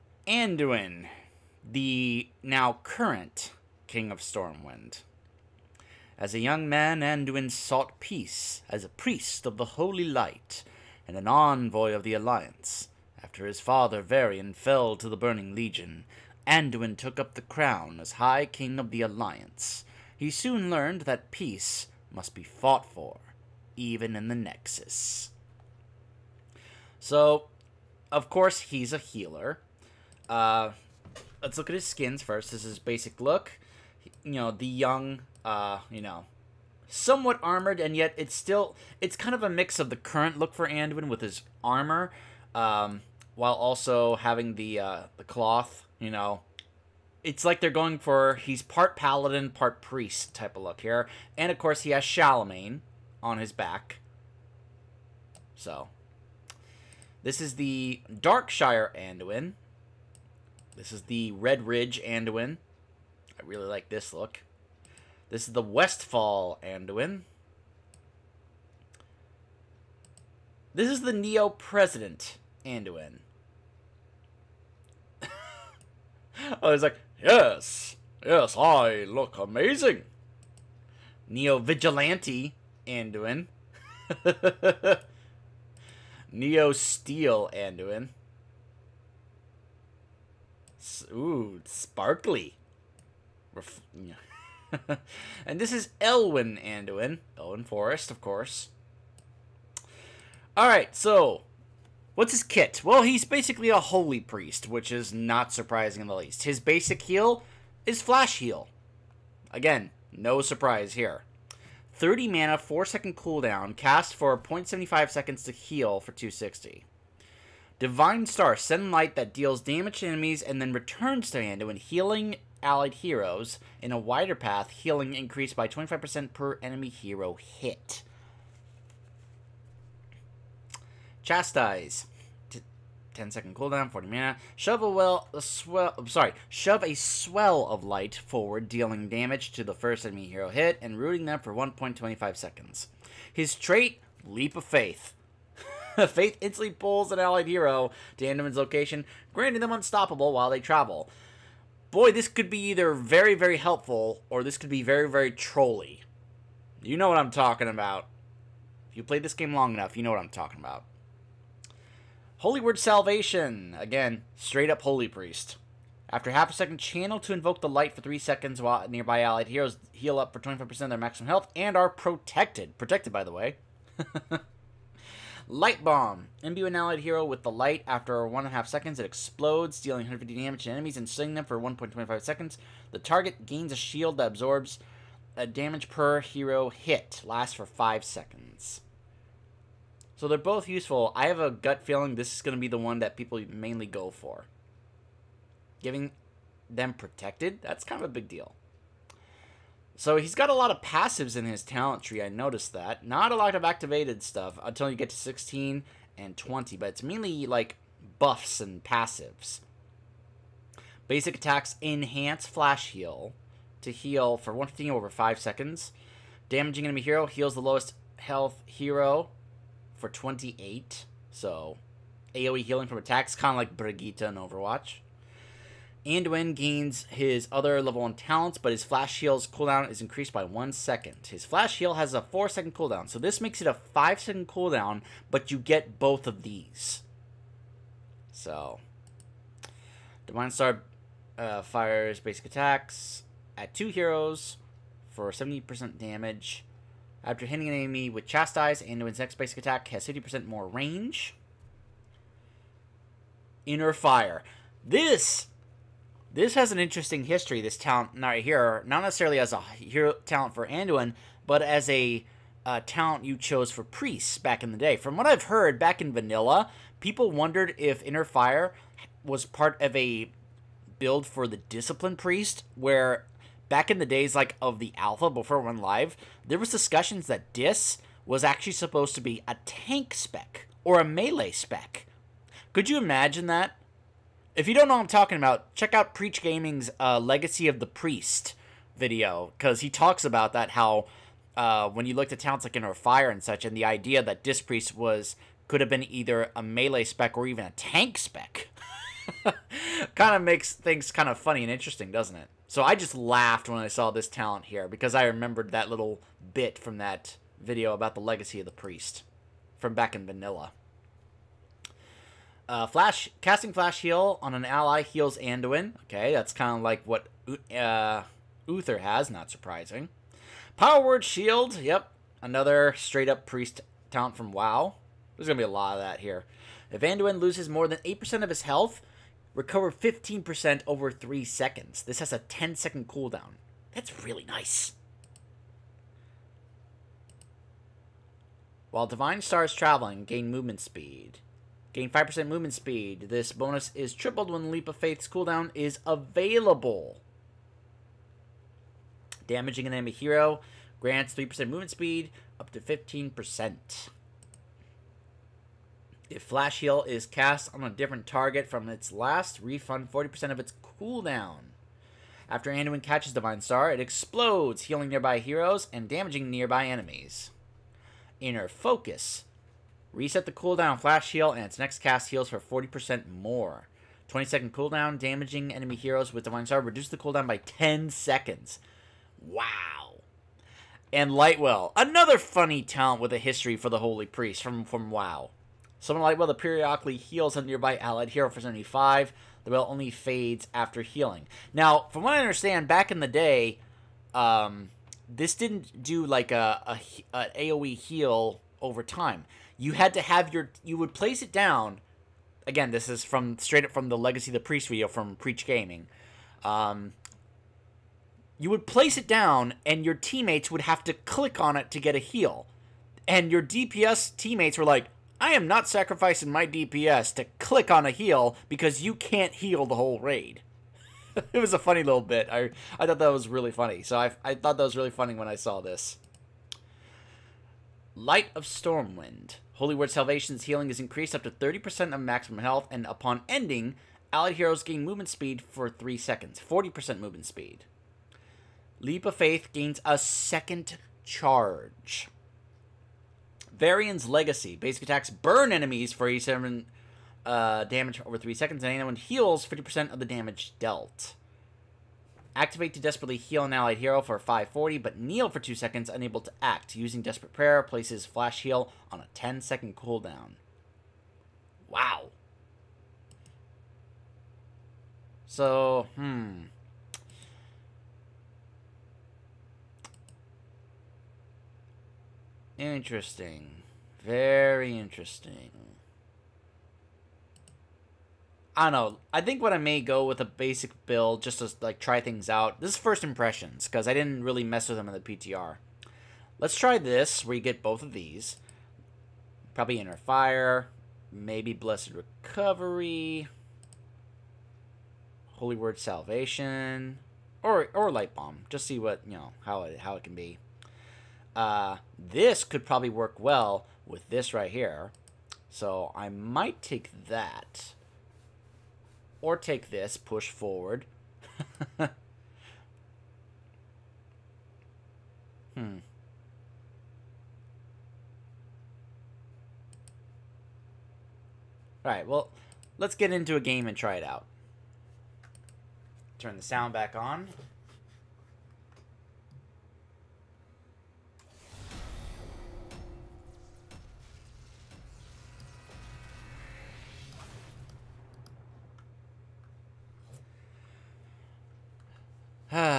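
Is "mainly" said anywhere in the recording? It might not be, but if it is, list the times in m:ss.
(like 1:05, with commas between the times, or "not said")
3:13, 3:27.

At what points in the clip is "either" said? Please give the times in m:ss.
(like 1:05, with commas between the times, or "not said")
2:32, 4:56.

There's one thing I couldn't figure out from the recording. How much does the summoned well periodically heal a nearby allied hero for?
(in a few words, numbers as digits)
75.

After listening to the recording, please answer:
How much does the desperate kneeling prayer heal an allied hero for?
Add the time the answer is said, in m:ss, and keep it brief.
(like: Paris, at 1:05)
540, at 7:34.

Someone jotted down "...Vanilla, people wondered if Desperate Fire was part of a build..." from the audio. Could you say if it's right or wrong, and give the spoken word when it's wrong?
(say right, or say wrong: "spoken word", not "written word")
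wrong: "Inner", not "Desperate".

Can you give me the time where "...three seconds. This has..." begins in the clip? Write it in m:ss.
5:31.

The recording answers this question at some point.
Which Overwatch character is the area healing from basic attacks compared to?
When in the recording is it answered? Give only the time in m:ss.
3:43.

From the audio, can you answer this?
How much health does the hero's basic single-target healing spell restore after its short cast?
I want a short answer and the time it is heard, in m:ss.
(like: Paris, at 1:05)
260, at 1:56.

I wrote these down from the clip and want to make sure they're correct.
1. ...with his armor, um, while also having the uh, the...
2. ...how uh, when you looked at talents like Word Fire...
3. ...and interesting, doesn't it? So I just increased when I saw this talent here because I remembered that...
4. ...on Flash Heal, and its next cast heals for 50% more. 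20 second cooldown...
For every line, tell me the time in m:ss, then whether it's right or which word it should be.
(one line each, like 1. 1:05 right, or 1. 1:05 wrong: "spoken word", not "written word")
1. 0:41 right
2. 4:50 wrong: "Inner", not "Word"
3. 5:01 wrong: "laughed", not "increased"
4. 6:10 wrong: "40", not "50".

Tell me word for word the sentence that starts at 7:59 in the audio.
I think what I may go with a basic build just to like try things out.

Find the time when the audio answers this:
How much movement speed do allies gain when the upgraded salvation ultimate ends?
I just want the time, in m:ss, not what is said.
7:16.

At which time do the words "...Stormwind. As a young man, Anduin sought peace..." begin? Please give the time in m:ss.
0:04.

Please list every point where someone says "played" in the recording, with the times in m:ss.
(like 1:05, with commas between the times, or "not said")
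2:39.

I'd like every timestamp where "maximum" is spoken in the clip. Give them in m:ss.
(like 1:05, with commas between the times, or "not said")
2:50, 7:12.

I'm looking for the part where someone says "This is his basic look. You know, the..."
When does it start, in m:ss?
0:32.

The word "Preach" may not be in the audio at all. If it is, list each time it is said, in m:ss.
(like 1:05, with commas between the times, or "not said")
4:46, 6:45.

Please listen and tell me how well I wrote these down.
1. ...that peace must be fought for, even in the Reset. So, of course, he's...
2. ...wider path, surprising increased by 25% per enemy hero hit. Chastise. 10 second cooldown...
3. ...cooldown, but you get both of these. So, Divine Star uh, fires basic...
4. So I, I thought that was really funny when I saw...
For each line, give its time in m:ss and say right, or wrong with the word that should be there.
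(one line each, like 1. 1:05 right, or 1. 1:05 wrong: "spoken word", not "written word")
1. 0:21 wrong: "Nexus", not "Reset"
2. 2:03 wrong: "healing", not "surprising"
3. 3:54 right
4. 7:04 right.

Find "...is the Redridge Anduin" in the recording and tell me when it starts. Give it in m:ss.
1:00.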